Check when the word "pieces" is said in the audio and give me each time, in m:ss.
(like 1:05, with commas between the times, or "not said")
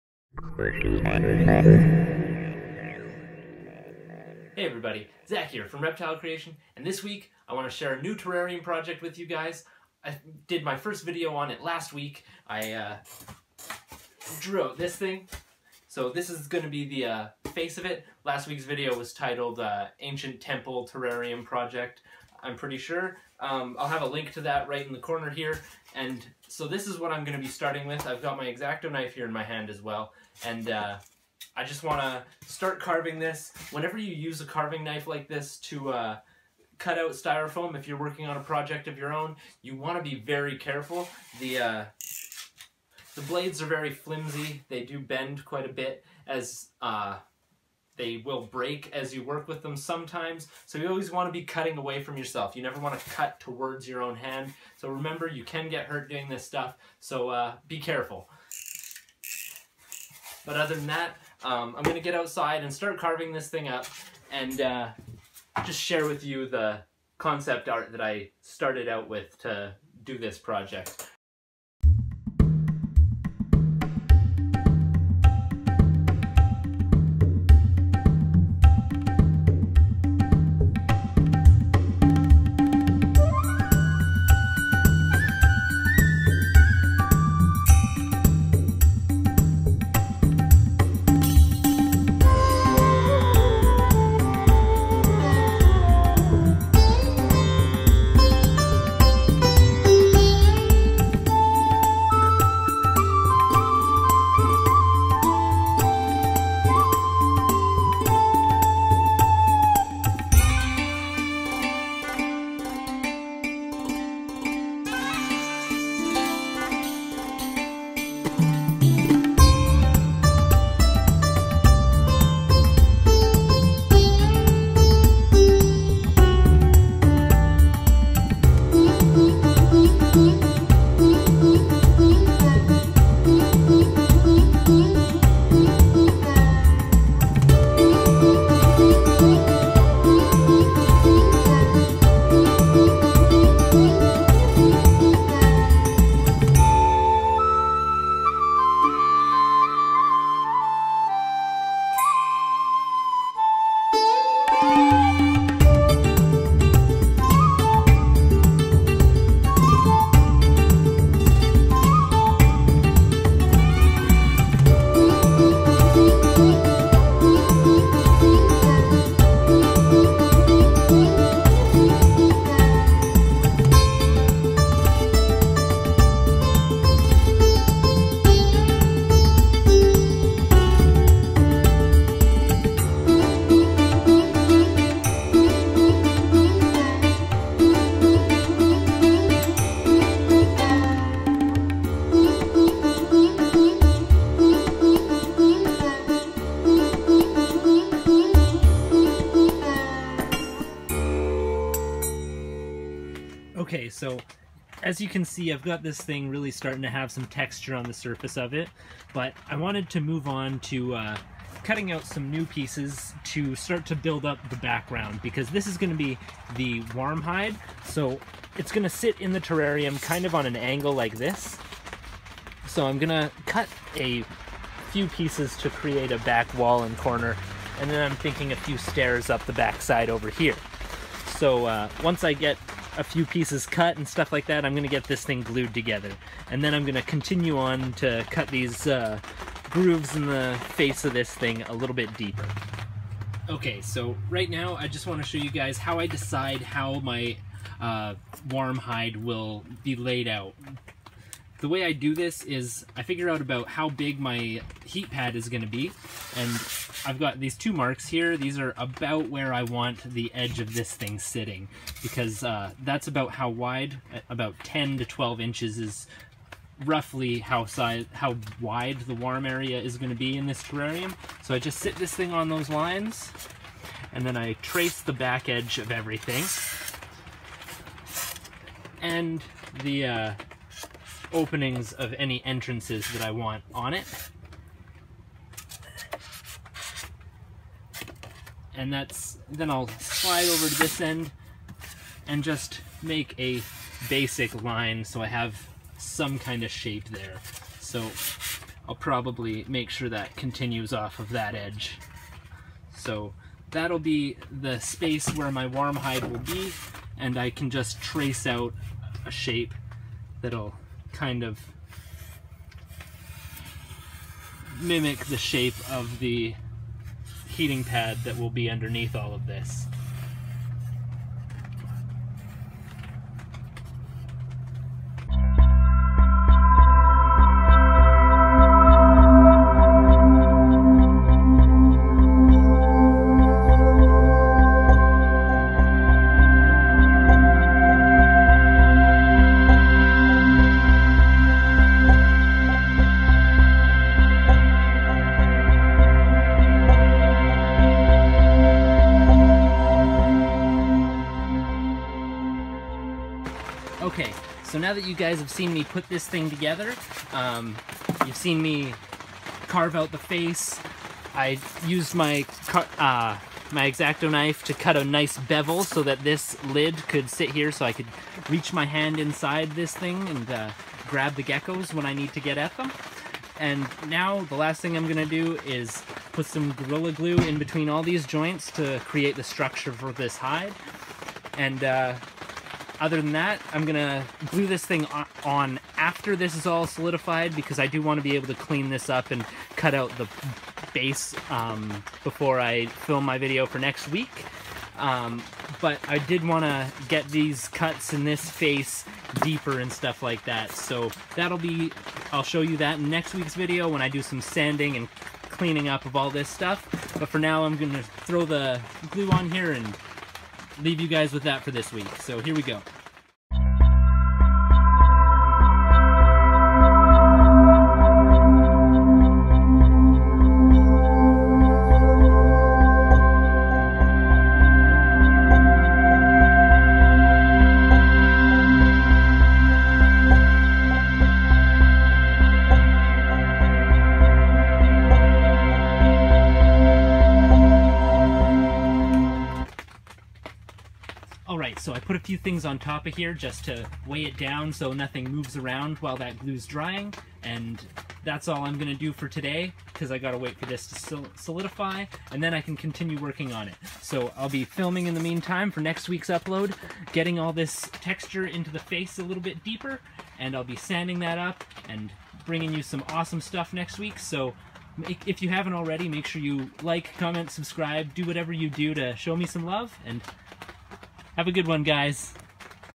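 3:32, 3:45, 3:53.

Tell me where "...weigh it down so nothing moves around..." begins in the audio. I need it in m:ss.
7:24.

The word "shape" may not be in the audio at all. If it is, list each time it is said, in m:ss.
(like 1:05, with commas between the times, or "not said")
4:56, 5:09, 5:15.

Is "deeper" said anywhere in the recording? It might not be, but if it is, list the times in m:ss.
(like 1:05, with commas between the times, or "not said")
4:02, 6:39, 7:39.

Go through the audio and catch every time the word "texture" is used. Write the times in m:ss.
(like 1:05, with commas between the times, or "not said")
3:27, 7:37.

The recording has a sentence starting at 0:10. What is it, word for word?
I did my first video on it last week.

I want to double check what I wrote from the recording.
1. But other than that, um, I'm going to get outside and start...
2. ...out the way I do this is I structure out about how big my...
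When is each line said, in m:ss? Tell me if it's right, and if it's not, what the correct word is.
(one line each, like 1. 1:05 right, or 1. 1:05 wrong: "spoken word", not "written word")
1. 1:00 right
2. 4:10 wrong: "figure", not "structure".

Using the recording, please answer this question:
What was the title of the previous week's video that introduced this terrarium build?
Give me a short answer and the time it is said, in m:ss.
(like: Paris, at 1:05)
Ancient Temple Terrarium Project, at 0:19.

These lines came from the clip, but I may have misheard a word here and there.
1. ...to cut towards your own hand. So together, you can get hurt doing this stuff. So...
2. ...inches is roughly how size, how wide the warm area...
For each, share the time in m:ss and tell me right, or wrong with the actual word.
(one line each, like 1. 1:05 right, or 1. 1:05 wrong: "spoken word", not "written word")
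1. 0:52 wrong: "remember", not "together"
2. 4:25 right.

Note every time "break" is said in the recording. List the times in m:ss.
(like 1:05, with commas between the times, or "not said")
0:48.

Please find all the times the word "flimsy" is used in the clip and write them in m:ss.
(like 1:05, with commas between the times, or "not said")
0:43.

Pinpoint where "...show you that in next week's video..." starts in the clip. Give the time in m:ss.
6:42.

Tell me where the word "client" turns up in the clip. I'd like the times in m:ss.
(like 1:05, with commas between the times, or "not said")
not said.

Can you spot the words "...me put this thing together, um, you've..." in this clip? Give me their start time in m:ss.
5:55.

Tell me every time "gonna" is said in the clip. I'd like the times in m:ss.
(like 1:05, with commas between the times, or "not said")
6:15, 6:23, 7:28.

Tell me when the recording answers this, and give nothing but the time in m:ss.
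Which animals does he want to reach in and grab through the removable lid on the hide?
6:11.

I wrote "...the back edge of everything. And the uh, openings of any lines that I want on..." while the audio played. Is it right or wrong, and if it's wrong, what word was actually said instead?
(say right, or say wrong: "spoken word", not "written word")
wrong: "entrances", not "lines".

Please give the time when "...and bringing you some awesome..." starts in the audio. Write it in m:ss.
7:41.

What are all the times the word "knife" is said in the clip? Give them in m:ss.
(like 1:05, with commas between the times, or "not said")
0:28, 0:34, 6:04.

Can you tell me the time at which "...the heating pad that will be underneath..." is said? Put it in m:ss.
5:16.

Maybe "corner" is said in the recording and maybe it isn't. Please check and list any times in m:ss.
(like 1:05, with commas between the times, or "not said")
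0:24, 3:46.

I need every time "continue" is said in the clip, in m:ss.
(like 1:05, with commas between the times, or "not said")
3:57, 5:00, 7:32.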